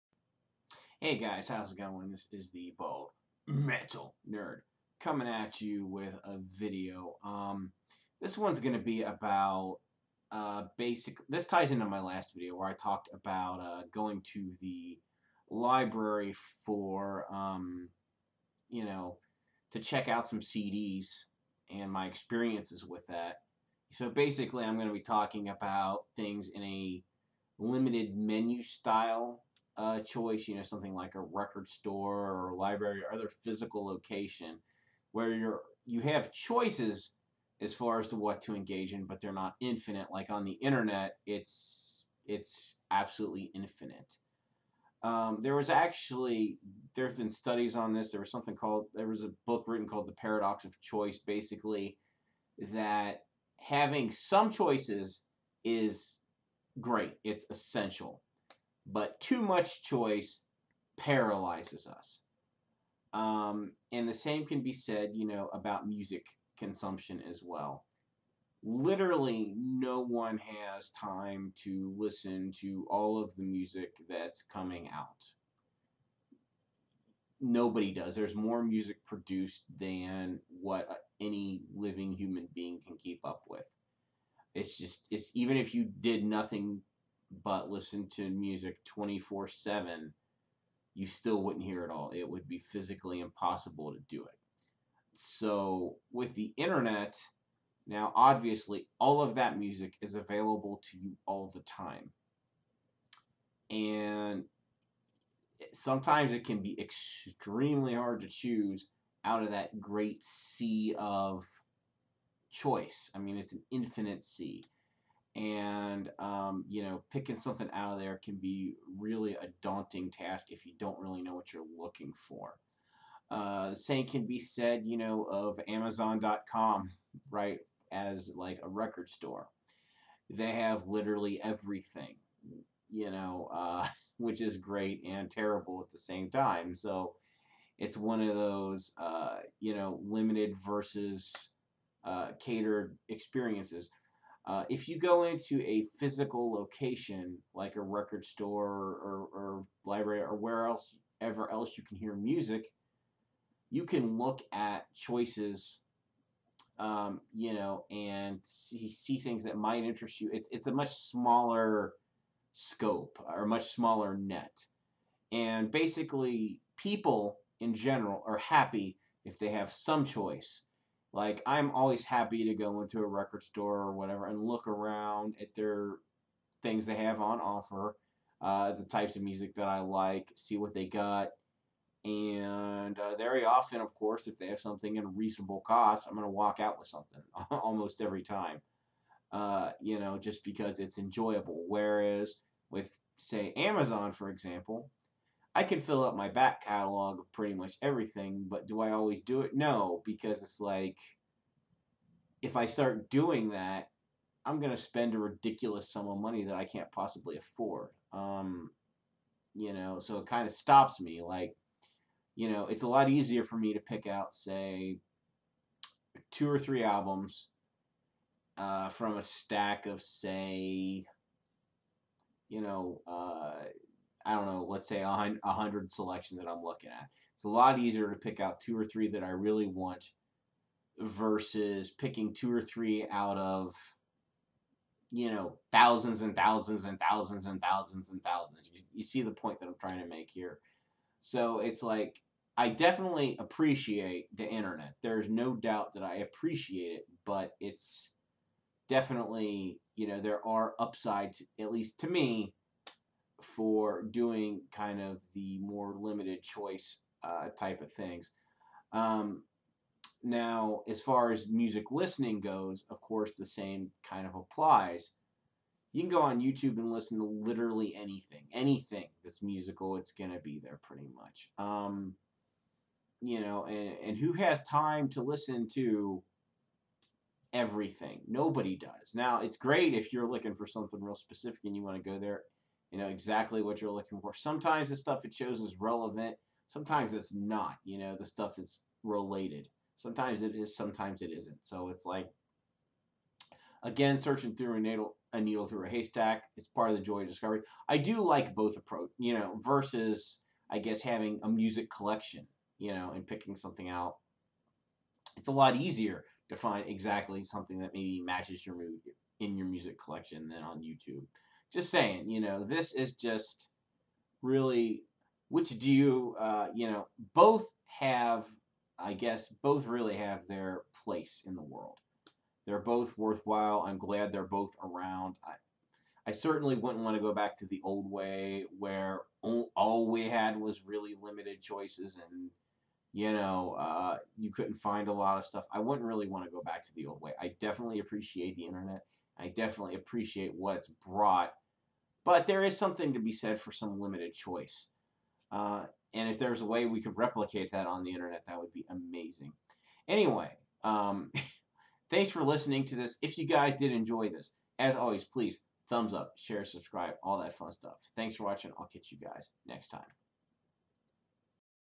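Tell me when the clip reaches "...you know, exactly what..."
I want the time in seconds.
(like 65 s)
282 s.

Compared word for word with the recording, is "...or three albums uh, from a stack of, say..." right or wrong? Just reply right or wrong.
right.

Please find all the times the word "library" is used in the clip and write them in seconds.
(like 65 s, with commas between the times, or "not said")
15 s, 32 s, 149 s.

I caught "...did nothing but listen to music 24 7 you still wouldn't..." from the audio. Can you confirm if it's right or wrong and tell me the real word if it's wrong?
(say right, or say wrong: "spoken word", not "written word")
right.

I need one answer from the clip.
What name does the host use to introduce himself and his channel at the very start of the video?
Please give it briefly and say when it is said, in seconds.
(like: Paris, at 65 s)
Bald Metal Nerd, at 2 s.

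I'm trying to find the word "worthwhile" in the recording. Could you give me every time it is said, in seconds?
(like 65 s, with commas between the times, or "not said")
323 s.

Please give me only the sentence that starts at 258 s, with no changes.
Um, now, as far as music listening goes, of course, the same kind of applies.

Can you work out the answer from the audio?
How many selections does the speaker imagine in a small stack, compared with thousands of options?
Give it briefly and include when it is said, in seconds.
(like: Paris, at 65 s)
100, at 225 s.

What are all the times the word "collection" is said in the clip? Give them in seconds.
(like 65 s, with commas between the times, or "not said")
301 s, 310 s.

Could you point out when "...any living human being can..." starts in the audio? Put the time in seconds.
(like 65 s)
81 s.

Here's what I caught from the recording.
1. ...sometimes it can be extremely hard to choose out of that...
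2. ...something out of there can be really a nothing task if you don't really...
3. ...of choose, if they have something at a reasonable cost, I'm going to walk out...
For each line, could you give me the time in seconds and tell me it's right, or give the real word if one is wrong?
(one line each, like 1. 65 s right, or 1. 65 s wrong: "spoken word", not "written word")
1. 105 s right
2. 117 s wrong: "daunting", not "nothing"
3. 183 s wrong: "course", not "choose".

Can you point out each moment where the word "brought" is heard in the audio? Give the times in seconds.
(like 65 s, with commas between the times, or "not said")
341 s.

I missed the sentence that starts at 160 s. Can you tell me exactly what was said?
It, it's a much smaller scope or much smaller net.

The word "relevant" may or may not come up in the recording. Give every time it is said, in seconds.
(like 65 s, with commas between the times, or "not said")
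285 s.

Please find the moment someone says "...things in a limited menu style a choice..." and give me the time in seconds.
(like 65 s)
26 s.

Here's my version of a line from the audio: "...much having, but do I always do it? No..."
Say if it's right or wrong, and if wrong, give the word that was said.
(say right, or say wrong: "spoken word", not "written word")
wrong: "everything", not "having".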